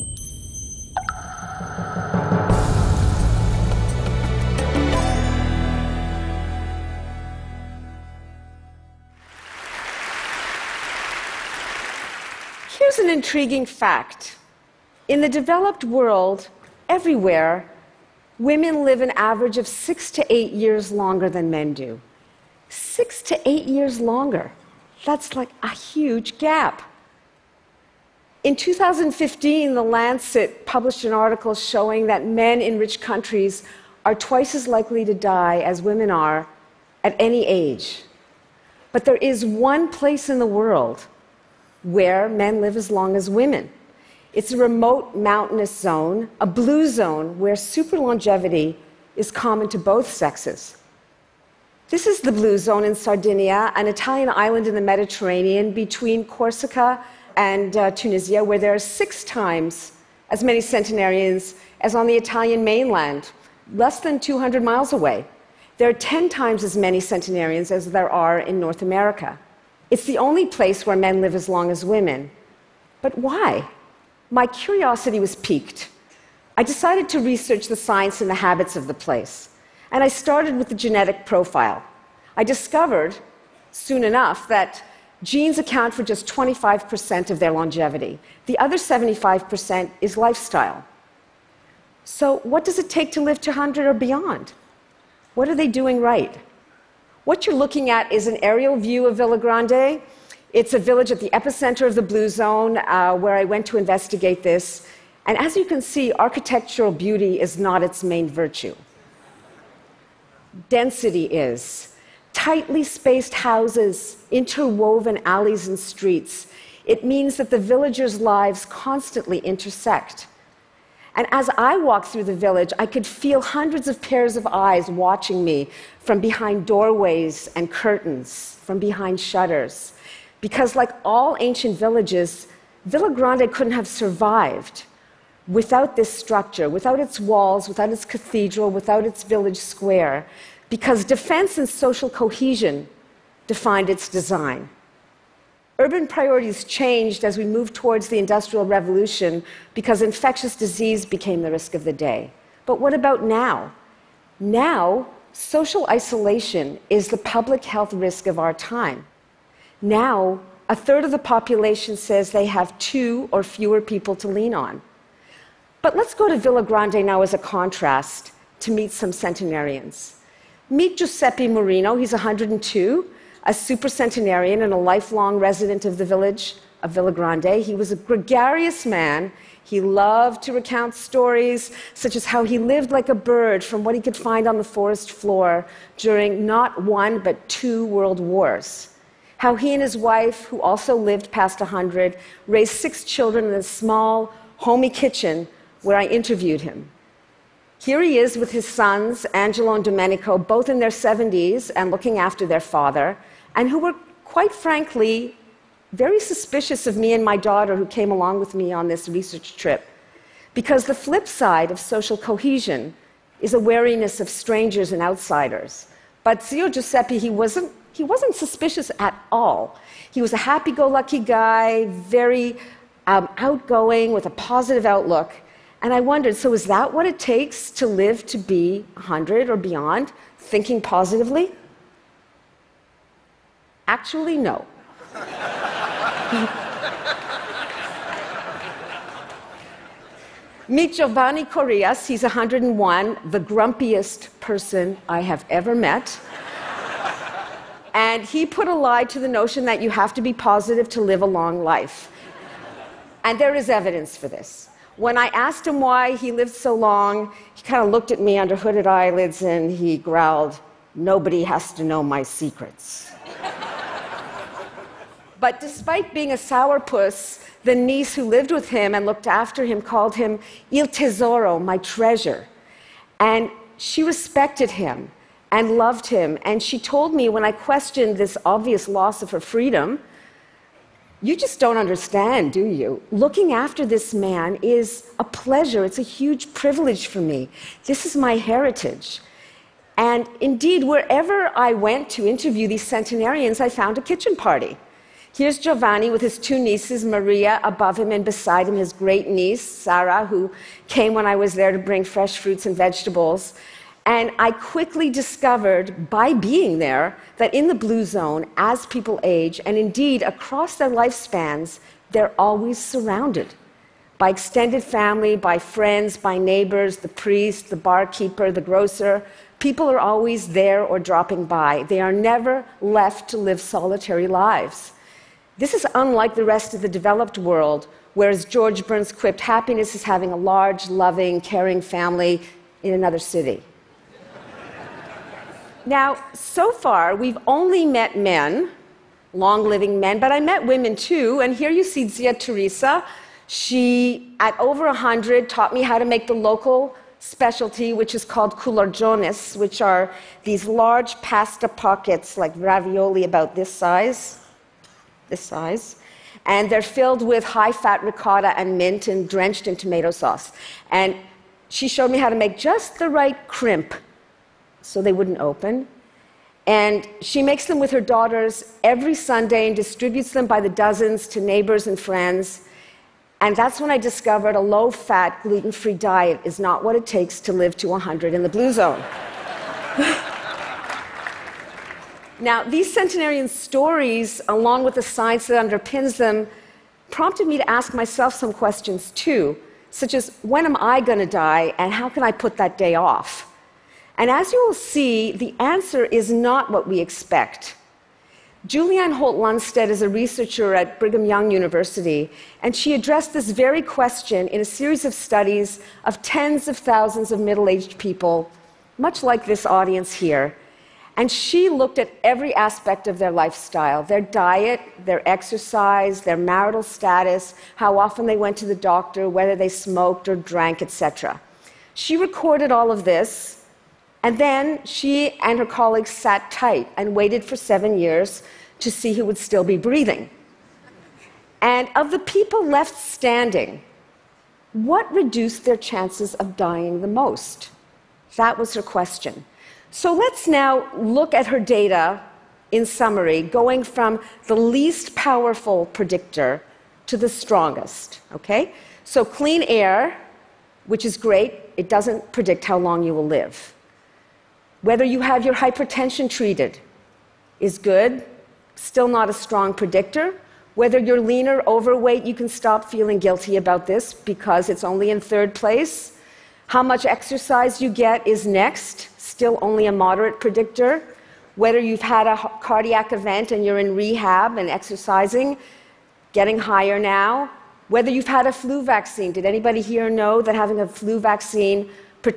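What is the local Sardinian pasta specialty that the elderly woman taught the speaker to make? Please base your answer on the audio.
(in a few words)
culurjones.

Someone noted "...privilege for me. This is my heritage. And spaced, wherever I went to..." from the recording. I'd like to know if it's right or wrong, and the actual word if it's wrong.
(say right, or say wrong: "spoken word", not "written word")
wrong: "indeed", not "spaced".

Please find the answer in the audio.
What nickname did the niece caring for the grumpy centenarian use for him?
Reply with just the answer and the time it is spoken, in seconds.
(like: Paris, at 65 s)
Il Tesoro, at 270 s.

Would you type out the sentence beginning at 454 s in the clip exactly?
Whether you have your hypertension treated is good, still not a strong predictor.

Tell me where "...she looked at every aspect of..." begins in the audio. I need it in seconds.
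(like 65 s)
411 s.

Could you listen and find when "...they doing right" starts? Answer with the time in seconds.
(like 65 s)
95 s.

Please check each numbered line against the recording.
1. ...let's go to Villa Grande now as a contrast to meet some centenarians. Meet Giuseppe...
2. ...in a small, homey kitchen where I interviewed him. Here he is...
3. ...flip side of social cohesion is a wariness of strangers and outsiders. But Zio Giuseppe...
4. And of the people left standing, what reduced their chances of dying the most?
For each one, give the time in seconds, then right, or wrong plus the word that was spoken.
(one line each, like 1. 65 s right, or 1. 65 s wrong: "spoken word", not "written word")
1. 165 s right
2. 193 s right
3. 210 s right
4. 431 s right.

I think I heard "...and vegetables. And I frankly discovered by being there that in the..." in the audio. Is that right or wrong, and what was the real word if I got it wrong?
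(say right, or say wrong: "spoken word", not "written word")
wrong: "quickly", not "frankly".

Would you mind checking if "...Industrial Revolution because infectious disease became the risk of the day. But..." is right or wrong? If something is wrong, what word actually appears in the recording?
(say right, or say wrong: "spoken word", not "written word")
right.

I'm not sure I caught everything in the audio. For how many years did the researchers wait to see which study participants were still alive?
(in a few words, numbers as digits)
7.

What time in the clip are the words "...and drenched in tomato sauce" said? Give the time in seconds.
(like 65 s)
359 s.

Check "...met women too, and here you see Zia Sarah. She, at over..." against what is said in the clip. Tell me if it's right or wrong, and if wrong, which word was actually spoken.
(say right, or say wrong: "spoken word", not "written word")
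wrong: "Teresa", not "Sarah".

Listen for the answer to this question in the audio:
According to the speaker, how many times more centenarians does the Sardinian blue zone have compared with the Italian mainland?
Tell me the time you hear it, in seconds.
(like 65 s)
58 s.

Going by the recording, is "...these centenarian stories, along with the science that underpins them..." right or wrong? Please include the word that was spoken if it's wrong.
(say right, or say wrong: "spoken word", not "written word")
right.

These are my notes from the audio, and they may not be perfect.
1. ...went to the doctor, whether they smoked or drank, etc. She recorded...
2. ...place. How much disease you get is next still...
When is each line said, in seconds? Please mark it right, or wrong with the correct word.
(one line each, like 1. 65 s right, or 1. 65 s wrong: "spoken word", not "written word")
1. 418 s right
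2. 465 s wrong: "exercise", not "disease".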